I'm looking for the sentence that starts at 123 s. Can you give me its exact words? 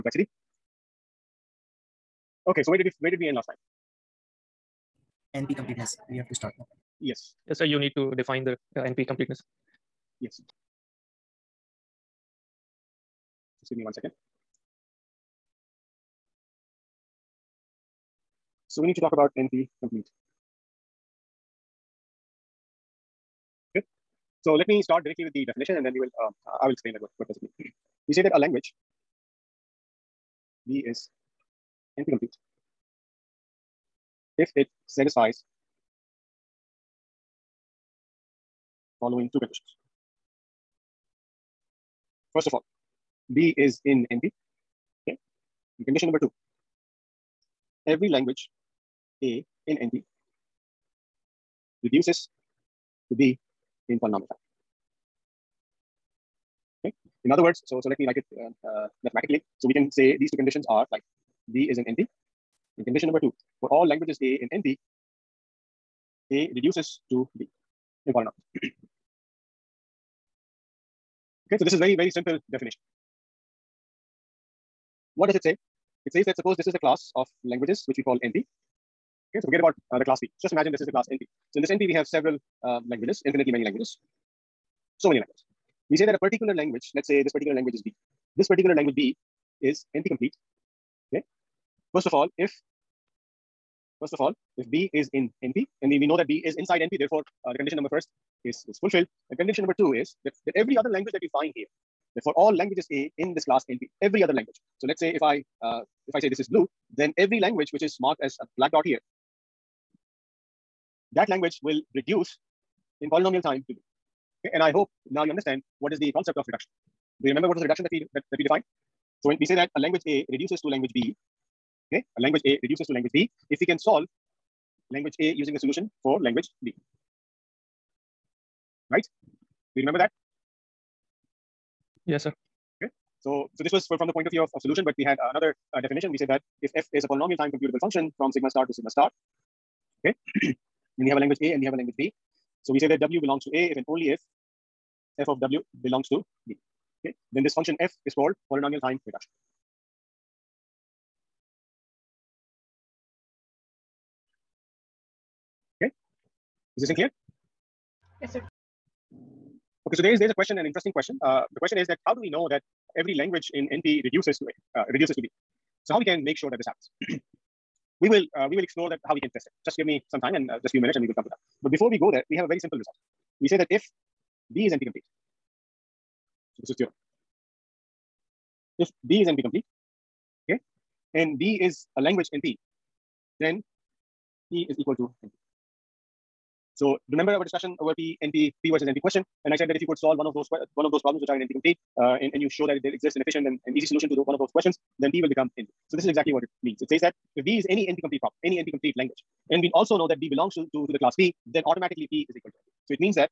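If we can solve language A using the solution for language B.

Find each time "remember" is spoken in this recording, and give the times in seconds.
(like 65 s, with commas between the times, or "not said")
117 s, 129 s, 187 s.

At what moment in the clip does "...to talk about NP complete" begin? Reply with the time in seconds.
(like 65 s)
18 s.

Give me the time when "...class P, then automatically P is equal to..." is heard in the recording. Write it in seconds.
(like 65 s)
200 s.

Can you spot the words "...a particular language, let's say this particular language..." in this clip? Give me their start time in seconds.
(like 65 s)
86 s.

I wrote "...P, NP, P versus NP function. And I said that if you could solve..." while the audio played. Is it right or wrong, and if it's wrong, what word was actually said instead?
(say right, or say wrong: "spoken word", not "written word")
wrong: "question", not "function".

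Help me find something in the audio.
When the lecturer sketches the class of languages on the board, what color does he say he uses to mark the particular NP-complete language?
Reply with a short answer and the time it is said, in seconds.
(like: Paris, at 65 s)
Blue, at 106 s.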